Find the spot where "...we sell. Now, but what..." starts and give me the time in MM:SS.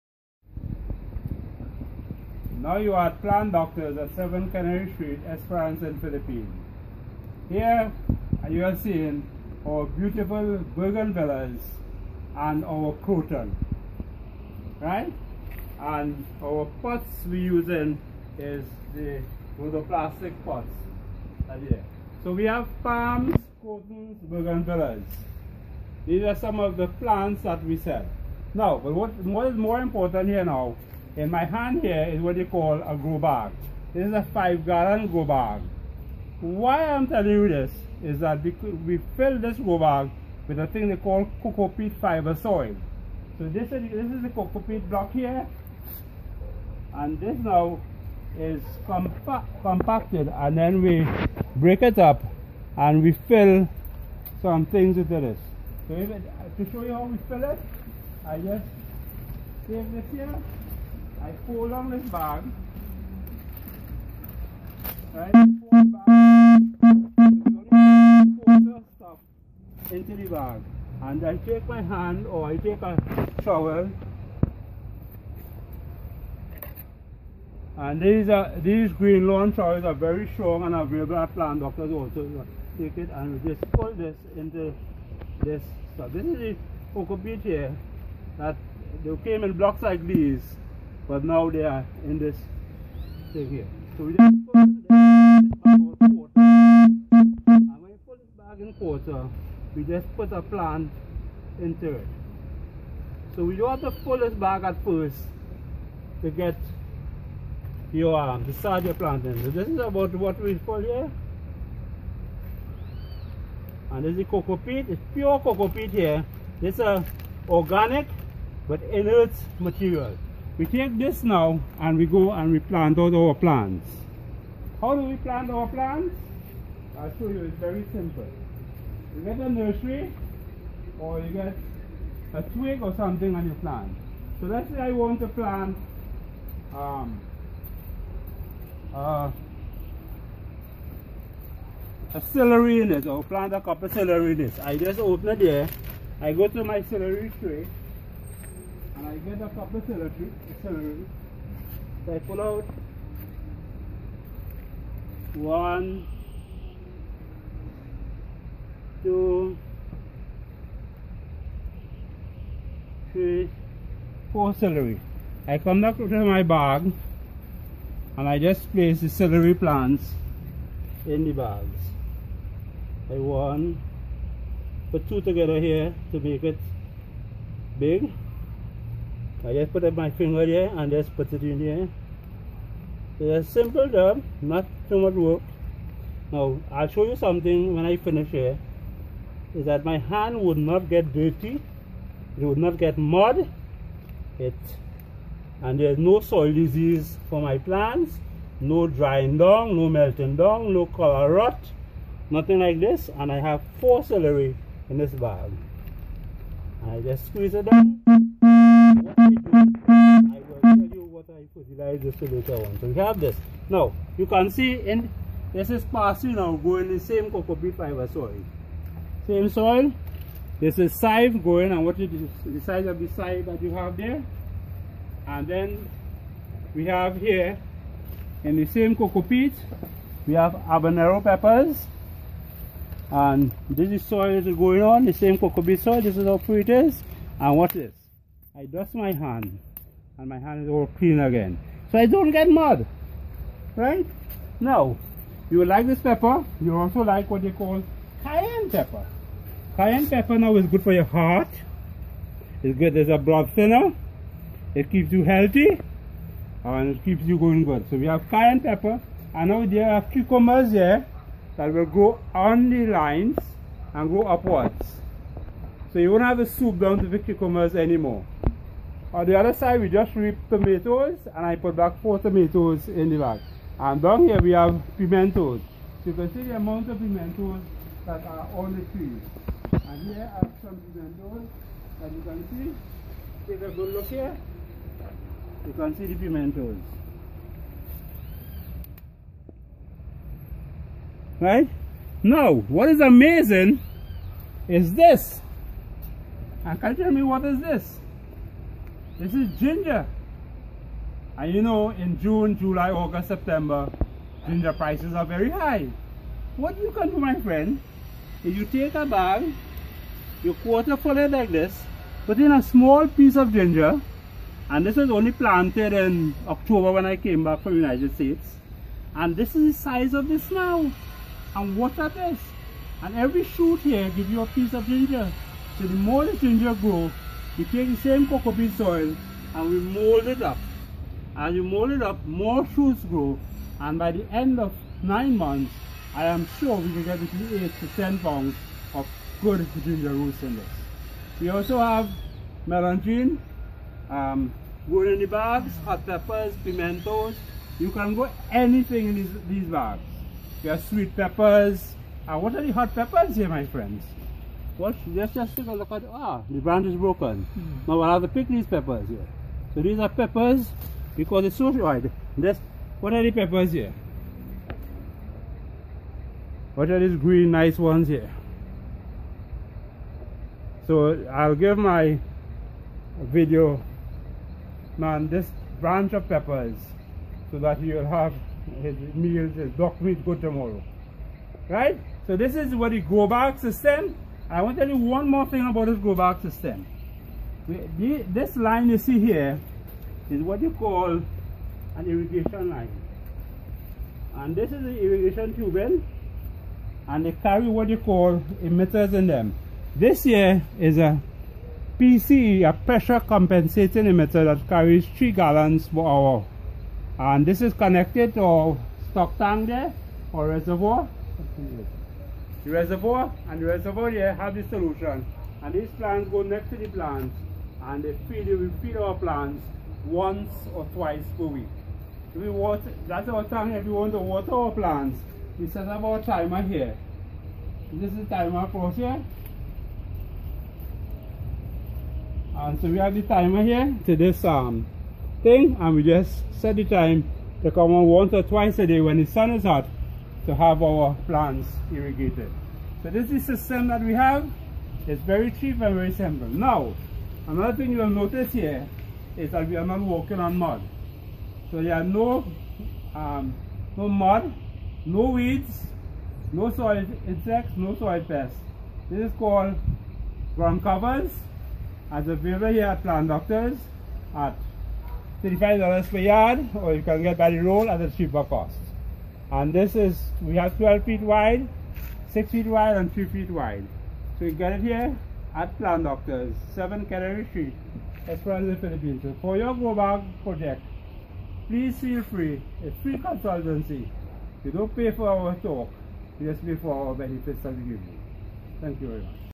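00:27.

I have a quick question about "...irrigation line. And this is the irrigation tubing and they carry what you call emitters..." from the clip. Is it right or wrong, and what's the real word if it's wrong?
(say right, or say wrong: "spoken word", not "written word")
right.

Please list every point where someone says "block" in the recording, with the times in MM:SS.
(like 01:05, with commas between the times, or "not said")
00:44, 01:29.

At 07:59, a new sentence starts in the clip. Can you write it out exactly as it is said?
So for your Grow Bag project, please feel free, a free consultancy.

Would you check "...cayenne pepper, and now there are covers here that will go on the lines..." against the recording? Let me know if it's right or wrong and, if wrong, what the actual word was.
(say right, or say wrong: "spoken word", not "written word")
wrong: "cucumbers", not "covers".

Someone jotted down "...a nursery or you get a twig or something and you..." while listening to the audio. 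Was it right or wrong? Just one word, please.
right.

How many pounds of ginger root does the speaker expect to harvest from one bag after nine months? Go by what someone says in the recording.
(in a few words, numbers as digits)
8 to 10.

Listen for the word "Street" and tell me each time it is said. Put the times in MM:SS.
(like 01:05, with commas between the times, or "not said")
00:04, 07:57.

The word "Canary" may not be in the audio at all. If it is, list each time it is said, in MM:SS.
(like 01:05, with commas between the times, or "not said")
00:04, 07:57.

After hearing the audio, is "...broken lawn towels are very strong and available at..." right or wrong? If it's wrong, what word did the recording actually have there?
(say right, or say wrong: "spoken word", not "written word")
wrong: "green", not "broken".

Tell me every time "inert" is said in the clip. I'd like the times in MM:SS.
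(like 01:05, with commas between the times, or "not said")
01:58.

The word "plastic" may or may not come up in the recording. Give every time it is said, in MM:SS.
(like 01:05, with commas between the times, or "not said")
00:19.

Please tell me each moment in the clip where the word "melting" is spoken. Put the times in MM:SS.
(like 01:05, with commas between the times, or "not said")
03:19.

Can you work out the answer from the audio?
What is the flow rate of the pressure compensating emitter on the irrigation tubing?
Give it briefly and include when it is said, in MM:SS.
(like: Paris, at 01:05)
3 gallons per hour, at 06:45.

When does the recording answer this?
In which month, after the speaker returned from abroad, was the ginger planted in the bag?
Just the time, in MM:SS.
05:16.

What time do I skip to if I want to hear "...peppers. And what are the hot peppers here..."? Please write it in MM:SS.
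05:51.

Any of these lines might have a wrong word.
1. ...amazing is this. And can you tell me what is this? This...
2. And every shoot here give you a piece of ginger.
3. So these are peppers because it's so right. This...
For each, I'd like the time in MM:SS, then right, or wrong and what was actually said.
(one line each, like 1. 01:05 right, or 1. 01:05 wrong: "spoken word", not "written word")
1. 04:53 right
2. 05:23 right
3. 05:59 right.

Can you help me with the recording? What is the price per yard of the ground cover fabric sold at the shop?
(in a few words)
$35.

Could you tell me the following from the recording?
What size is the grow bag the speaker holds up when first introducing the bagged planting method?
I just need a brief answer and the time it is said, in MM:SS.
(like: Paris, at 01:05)
5 gallon, at 00:34.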